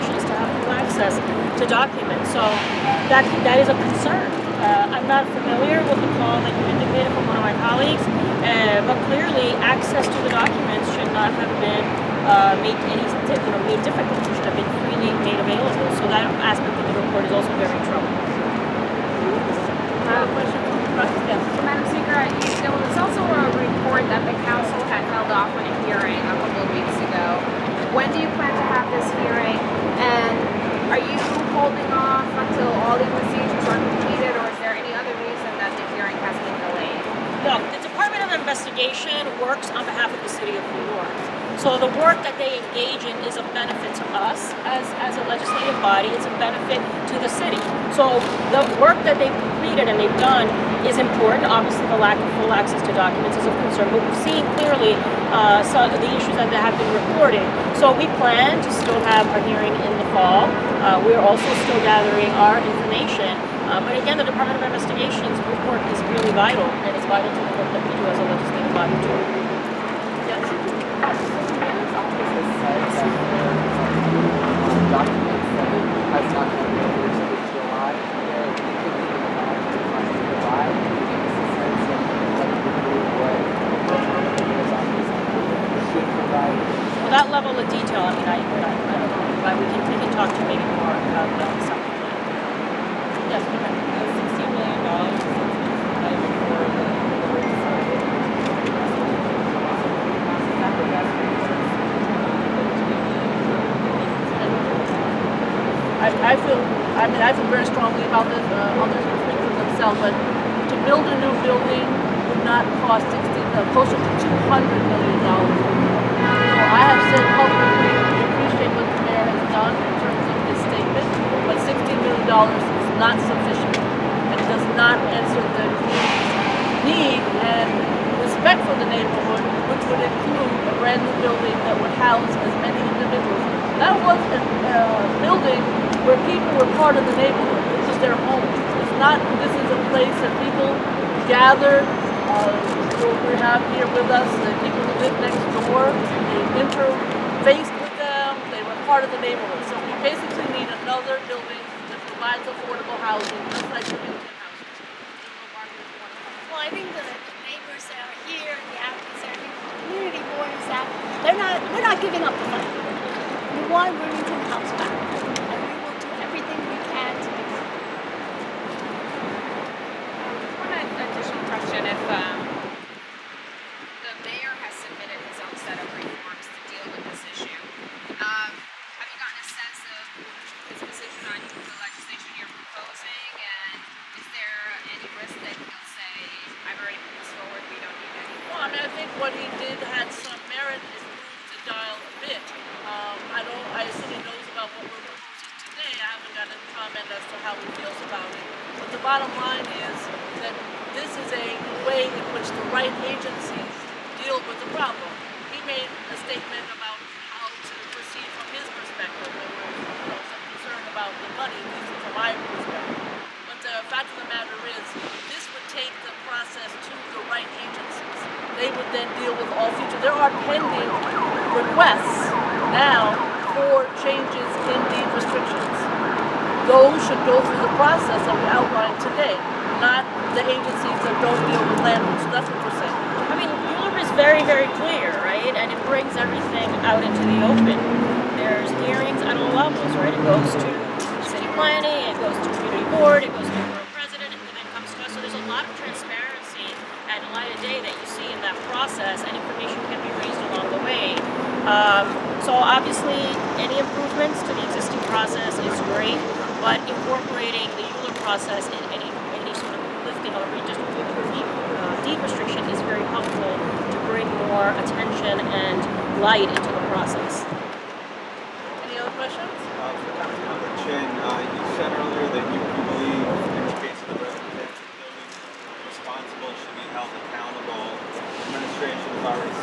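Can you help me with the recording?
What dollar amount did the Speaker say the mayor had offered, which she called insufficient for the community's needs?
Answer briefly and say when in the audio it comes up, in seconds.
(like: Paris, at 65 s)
$16 million, at 121 s.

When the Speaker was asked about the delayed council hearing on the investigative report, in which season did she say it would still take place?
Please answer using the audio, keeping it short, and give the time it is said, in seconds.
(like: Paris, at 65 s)
fall, at 60 s.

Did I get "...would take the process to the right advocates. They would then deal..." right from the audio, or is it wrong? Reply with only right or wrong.
wrong.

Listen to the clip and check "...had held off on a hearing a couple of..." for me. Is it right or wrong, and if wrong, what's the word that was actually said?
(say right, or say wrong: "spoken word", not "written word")
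right.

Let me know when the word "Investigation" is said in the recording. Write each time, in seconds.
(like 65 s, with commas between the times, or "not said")
38 s, 64 s.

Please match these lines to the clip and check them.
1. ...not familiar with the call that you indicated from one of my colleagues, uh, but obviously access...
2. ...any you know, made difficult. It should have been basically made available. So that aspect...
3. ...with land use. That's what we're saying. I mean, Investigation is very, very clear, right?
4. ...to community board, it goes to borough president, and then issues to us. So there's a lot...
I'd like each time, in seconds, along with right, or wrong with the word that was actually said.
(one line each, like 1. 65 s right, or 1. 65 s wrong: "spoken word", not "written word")
1. 5 s wrong: "clearly", not "obviously"
2. 12 s wrong: "freely", not "basically"
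3. 231 s wrong: "ULURP", not "Investigation"
4. 242 s wrong: "comes", not "issues".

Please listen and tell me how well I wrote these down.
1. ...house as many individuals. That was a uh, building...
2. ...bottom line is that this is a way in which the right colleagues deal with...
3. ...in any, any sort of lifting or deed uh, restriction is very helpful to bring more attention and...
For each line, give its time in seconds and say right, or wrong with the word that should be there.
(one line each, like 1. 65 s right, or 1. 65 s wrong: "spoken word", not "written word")
1. 132 s right
2. 199 s wrong: "agencies", not "colleagues"
3. 258 s right.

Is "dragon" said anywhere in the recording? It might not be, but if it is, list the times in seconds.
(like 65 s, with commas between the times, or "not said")
not said.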